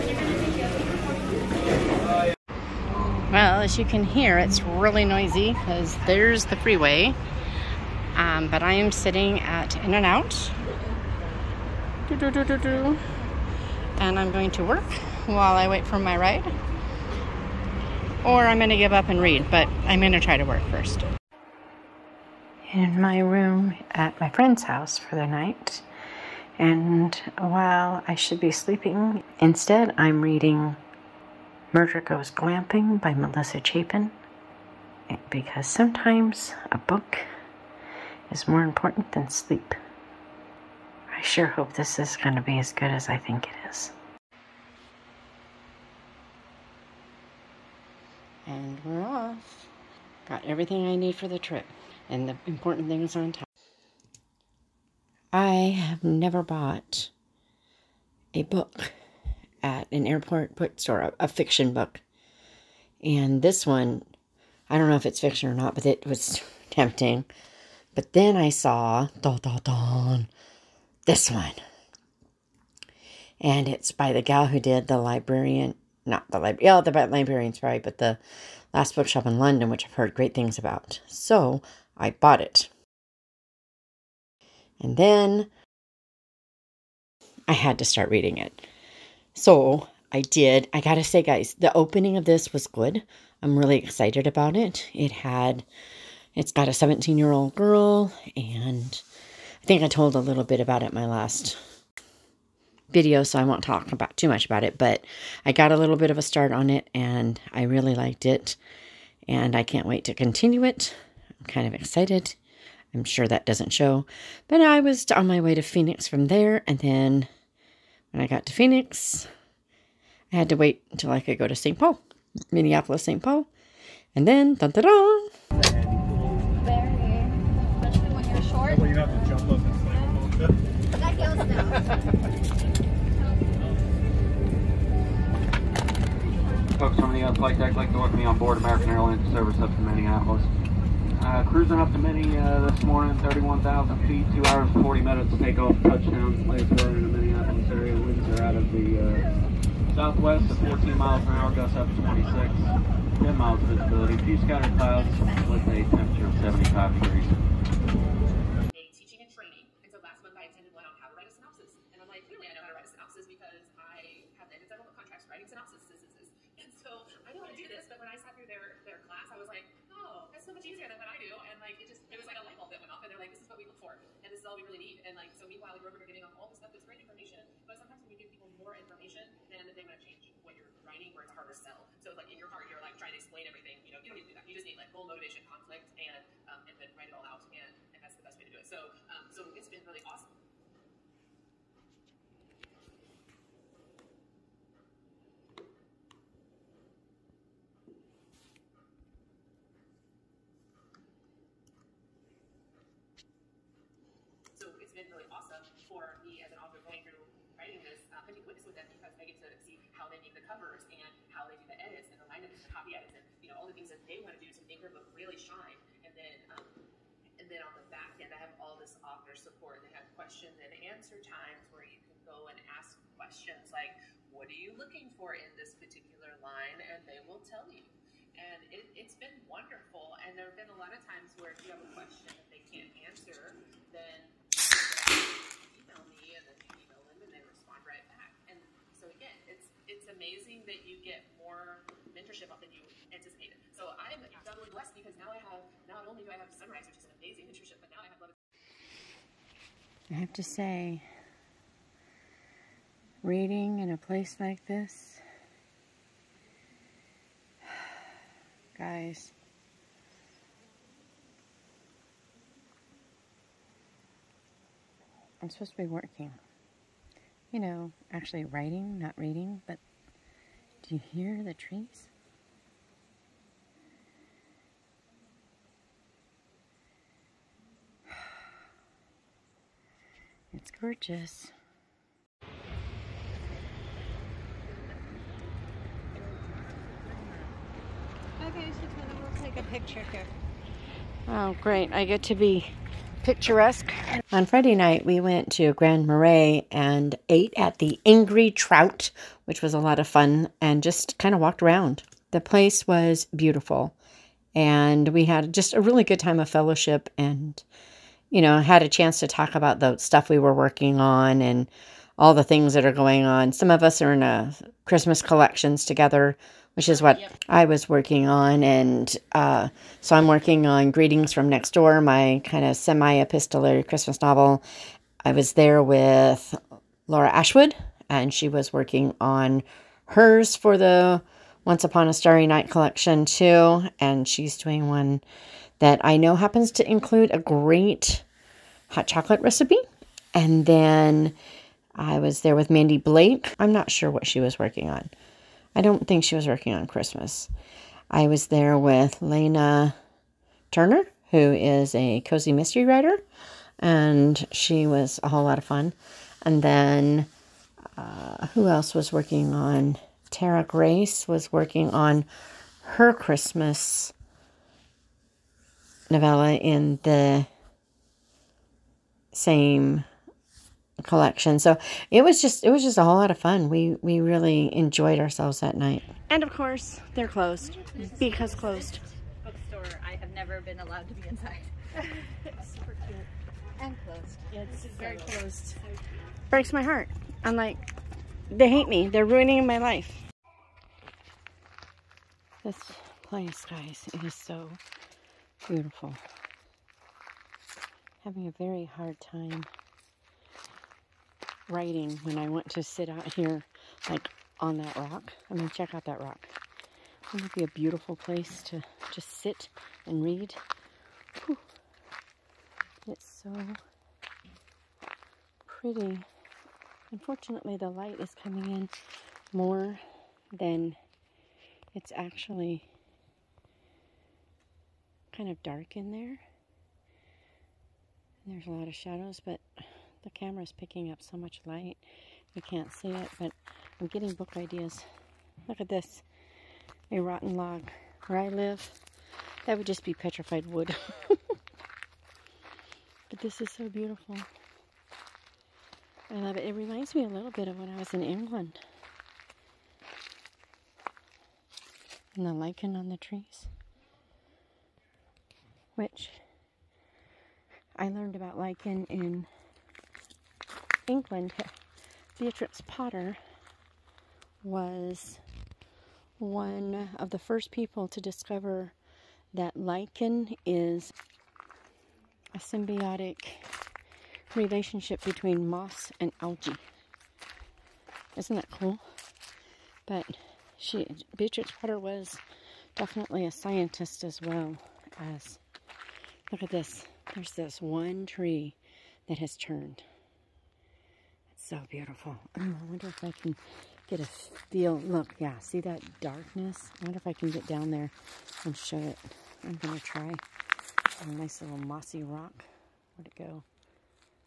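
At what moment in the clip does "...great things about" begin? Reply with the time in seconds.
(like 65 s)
80 s.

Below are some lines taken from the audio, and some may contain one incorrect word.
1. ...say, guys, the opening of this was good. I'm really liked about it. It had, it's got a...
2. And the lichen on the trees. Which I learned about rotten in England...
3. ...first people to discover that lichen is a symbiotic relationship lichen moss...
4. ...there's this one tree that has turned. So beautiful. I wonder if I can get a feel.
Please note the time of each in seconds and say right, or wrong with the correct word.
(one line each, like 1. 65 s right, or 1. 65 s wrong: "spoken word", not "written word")
1. 91 s wrong: "excited", not "liked"
2. 452 s wrong: "lichen", not "rotten"
3. 467 s wrong: "between", not "lichen"
4. 487 s right.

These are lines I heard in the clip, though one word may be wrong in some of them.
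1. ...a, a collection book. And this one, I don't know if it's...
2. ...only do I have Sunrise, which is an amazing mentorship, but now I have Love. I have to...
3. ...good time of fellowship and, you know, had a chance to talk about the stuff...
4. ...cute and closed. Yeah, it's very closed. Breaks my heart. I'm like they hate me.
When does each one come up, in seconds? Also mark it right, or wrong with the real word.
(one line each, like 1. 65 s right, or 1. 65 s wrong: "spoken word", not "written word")
1. 61 s wrong: "fiction", not "collection"
2. 246 s right
3. 306 s right
4. 383 s right.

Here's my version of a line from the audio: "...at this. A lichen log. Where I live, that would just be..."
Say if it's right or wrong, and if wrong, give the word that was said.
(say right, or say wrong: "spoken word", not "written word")
wrong: "rotten", not "lichen".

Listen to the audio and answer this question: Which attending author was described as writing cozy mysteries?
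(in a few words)
Lena Turner.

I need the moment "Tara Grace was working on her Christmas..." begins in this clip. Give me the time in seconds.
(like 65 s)
360 s.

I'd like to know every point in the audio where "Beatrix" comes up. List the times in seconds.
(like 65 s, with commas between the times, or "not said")
462 s, 481 s.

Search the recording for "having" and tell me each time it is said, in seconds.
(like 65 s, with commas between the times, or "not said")
208 s, 398 s.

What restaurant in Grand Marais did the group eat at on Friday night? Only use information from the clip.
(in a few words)
Angry Trout.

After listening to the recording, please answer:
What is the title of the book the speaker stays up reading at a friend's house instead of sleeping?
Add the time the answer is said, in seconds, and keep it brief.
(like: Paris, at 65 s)
Murder Goes Glamping, at 31 s.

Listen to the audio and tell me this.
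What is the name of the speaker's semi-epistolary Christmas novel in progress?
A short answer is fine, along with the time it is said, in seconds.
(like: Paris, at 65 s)
Greetings from Next Door, at 320 s.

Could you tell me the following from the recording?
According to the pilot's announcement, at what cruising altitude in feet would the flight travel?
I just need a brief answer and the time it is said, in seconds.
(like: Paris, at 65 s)
31,000, at 143 s.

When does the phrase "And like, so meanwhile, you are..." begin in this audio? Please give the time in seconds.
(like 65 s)
175 s.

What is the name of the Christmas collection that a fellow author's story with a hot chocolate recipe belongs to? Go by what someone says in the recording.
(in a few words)
Once Upon a Starry Night.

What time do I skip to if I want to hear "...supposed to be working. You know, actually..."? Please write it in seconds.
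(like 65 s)
265 s.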